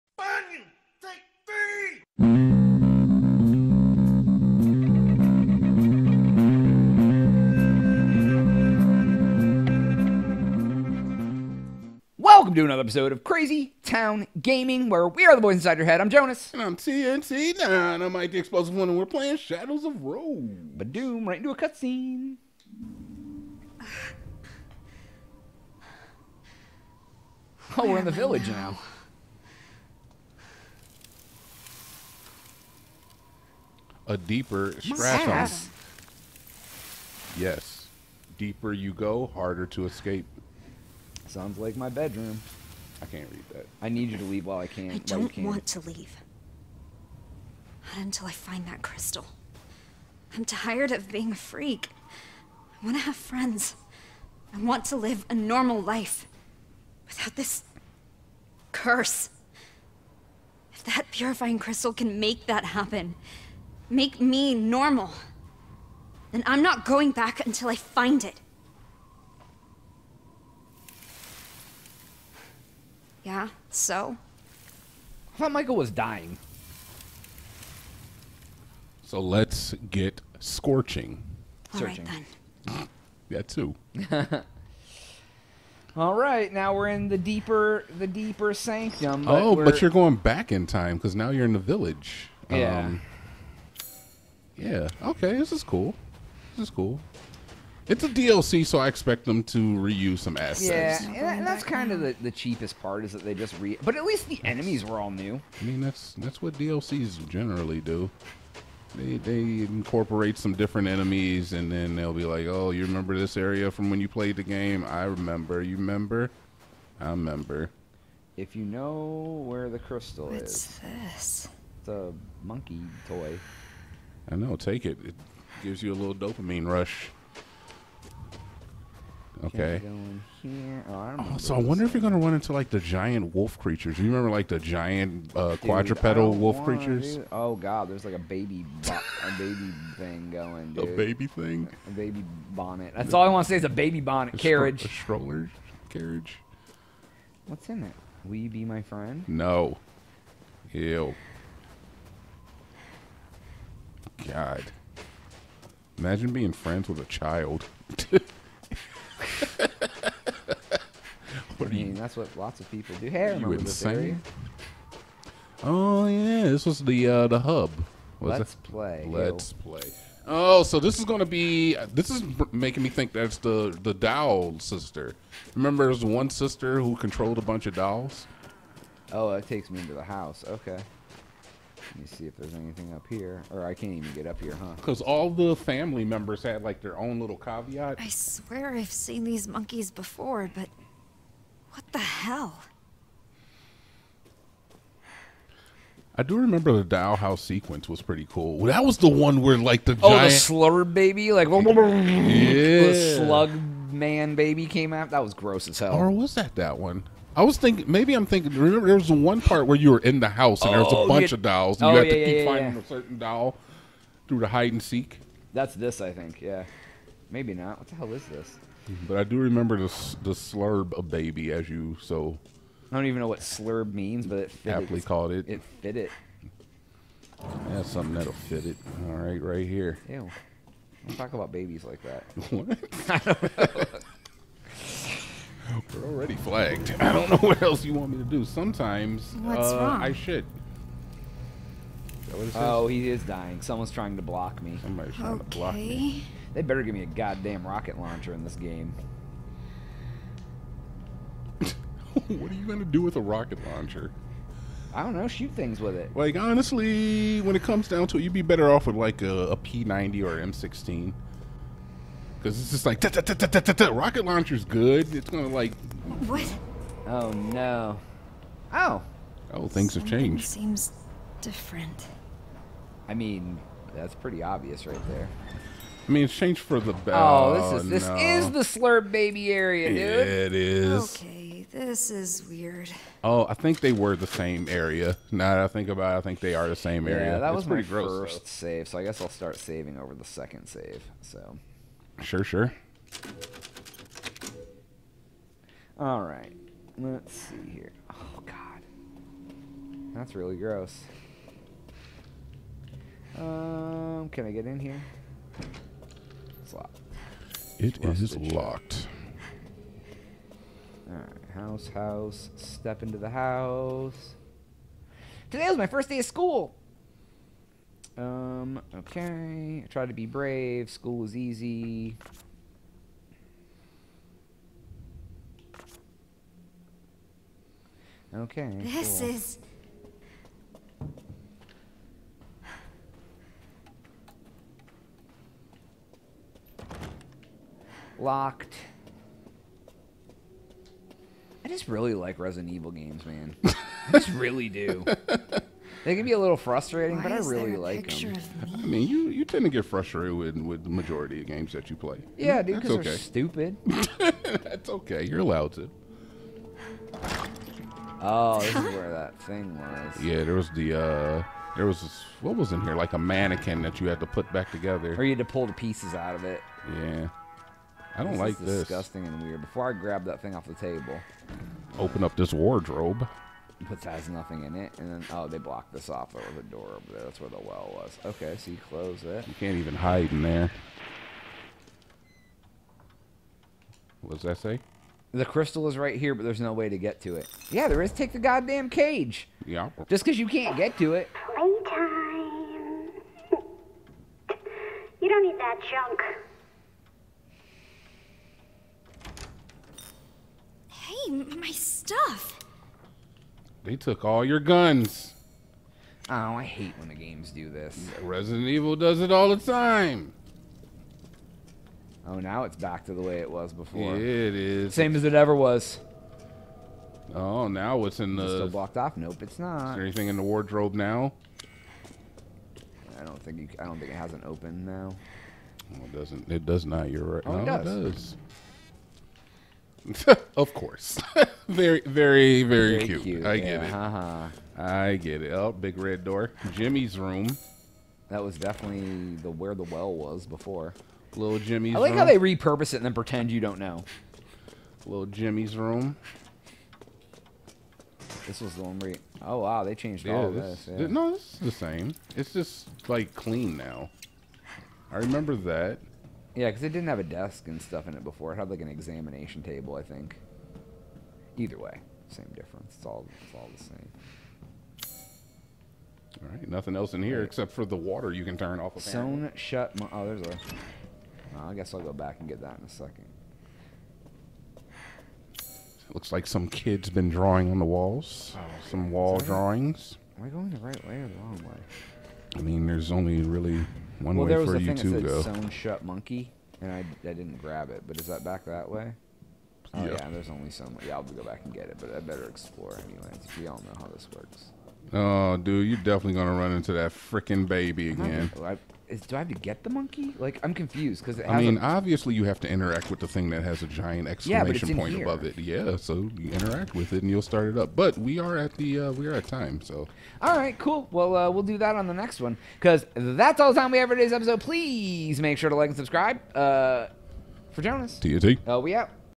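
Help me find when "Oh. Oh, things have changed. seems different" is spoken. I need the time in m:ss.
4:28.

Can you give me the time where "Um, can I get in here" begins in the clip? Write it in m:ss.
5:03.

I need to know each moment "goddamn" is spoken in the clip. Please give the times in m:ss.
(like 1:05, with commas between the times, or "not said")
4:07, 6:28.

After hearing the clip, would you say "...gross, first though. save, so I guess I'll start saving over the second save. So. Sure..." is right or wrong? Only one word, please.
right.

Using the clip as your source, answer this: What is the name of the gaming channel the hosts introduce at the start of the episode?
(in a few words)
Crazy Town Gaming.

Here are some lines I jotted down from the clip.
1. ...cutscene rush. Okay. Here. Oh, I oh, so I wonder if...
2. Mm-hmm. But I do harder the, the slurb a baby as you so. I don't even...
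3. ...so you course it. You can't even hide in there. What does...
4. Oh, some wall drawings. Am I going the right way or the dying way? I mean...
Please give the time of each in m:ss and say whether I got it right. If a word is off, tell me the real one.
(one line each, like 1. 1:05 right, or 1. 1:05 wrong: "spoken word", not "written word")
1. 2:06 wrong: "dopamine", not "cutscene"
2. 3:38 wrong: "remember", not "harder"
3. 6:18 wrong: "close", not "course"
4. 7:58 wrong: "wrong", not "dying".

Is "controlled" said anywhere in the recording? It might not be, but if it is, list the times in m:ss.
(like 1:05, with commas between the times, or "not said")
2:56.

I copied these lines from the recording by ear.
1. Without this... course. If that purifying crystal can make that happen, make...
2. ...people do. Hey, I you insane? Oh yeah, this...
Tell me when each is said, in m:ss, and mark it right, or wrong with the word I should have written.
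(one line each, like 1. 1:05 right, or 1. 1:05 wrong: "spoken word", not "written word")
1. 0:57 wrong: "curse", not "course"
2. 2:42 right.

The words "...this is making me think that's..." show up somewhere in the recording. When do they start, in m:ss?
2:51.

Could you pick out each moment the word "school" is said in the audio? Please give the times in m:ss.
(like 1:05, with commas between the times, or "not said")
5:16, 5:20.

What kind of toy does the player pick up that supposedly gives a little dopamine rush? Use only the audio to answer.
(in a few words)
Monkey toy.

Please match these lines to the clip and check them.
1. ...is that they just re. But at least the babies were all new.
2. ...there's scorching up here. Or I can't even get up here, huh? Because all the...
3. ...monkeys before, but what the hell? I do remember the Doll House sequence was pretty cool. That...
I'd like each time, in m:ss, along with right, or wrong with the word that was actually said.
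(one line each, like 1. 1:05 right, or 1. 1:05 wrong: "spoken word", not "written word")
1. 1:43 wrong: "enemies", not "babies"
2. 3:02 wrong: "anything", not "scorching"
3. 3:09 right.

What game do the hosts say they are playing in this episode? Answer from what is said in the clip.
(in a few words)
Shadows of Rose.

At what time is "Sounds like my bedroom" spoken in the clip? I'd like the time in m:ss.
0:41.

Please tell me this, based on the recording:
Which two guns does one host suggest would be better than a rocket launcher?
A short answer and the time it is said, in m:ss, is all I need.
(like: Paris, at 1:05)
P90 or M16, at 4:19.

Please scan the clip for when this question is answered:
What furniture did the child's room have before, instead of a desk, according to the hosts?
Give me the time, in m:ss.
7:38.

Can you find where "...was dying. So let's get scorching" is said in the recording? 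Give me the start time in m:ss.
1:15.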